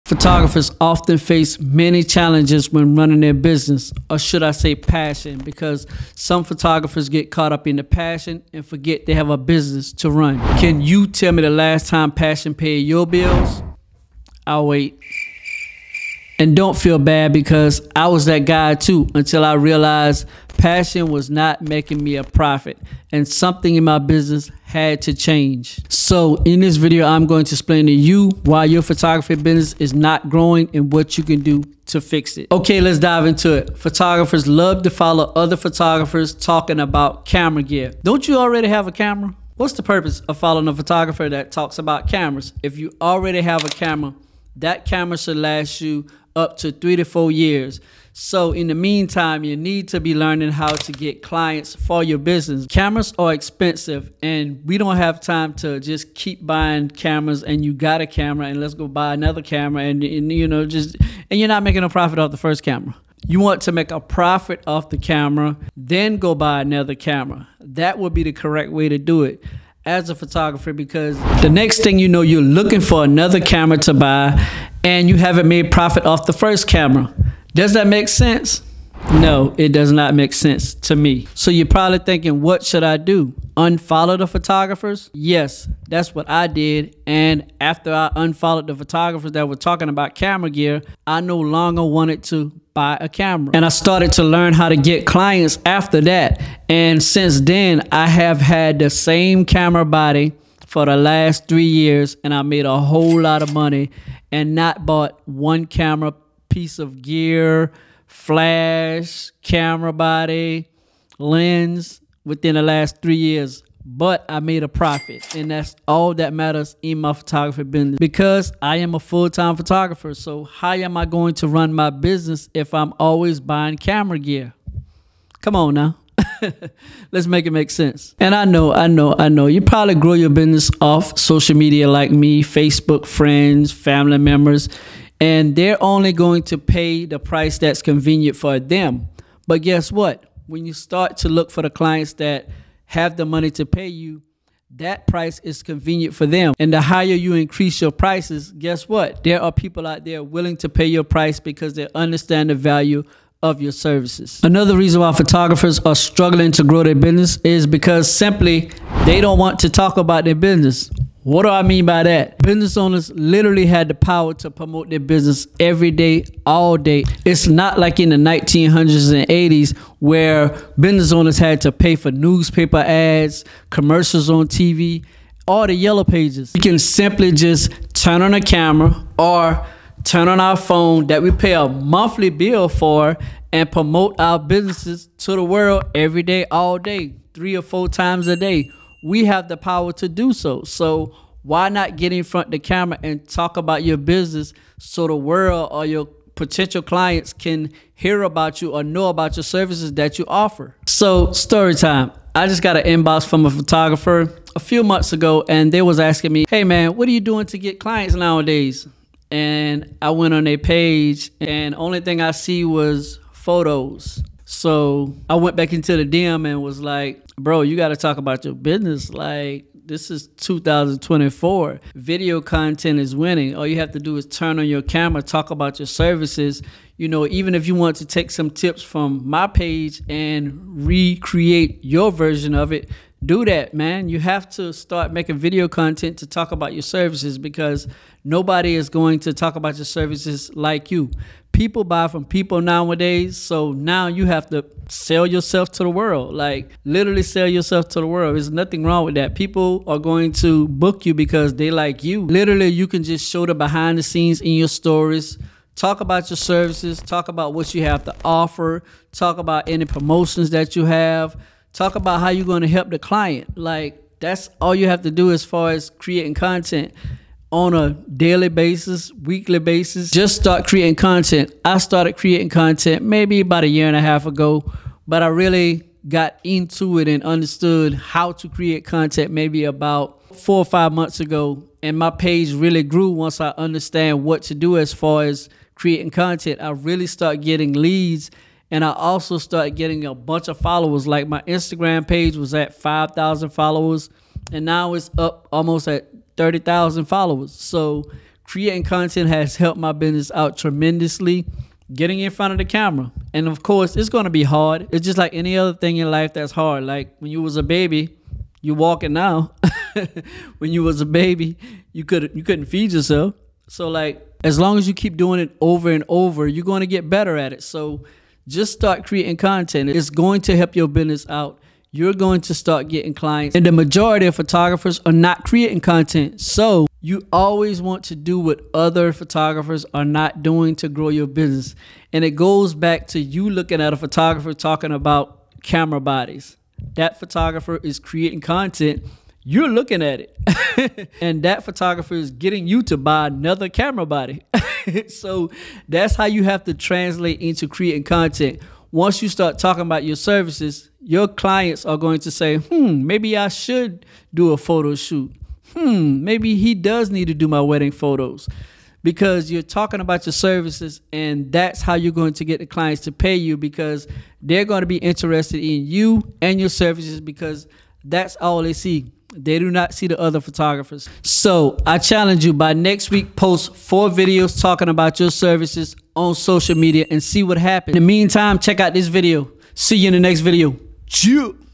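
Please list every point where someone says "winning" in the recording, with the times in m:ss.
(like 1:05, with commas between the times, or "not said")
3:43.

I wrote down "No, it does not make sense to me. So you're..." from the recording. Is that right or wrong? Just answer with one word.
right.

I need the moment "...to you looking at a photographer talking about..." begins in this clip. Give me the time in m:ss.
5:33.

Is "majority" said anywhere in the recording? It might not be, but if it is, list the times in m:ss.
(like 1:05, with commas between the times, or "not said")
5:23.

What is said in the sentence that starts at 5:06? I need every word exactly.
Like when you was a baby, you walking now.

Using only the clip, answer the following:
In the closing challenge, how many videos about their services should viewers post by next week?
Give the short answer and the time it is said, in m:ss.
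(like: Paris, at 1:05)
4, at 6:13.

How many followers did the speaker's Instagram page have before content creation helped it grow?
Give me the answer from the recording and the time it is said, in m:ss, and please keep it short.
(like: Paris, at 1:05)
5,000, at 4:52.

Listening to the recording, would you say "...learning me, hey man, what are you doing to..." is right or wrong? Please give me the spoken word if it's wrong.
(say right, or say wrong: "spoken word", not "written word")
wrong: "asking", not "learning".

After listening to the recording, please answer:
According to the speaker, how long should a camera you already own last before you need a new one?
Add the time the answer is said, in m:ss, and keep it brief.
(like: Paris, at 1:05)
3 to 4 years, at 0:46.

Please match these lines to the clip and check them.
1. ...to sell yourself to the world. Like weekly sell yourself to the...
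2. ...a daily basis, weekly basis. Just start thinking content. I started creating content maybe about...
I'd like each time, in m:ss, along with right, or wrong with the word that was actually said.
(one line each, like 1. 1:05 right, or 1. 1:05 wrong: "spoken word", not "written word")
1. 4:04 wrong: "literally", not "weekly"
2. 4:27 wrong: "creating", not "thinking".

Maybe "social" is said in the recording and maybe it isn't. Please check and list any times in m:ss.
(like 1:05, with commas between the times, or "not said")
2:11, 6:16.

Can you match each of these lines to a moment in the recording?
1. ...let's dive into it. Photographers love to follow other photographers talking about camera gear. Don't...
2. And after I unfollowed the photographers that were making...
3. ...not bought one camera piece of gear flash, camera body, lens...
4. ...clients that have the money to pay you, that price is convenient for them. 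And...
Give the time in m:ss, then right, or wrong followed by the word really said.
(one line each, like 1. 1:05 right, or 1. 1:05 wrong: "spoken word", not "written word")
1. 0:32 right
2. 1:27 wrong: "talking", not "making"
3. 1:44 right
4. 2:21 right.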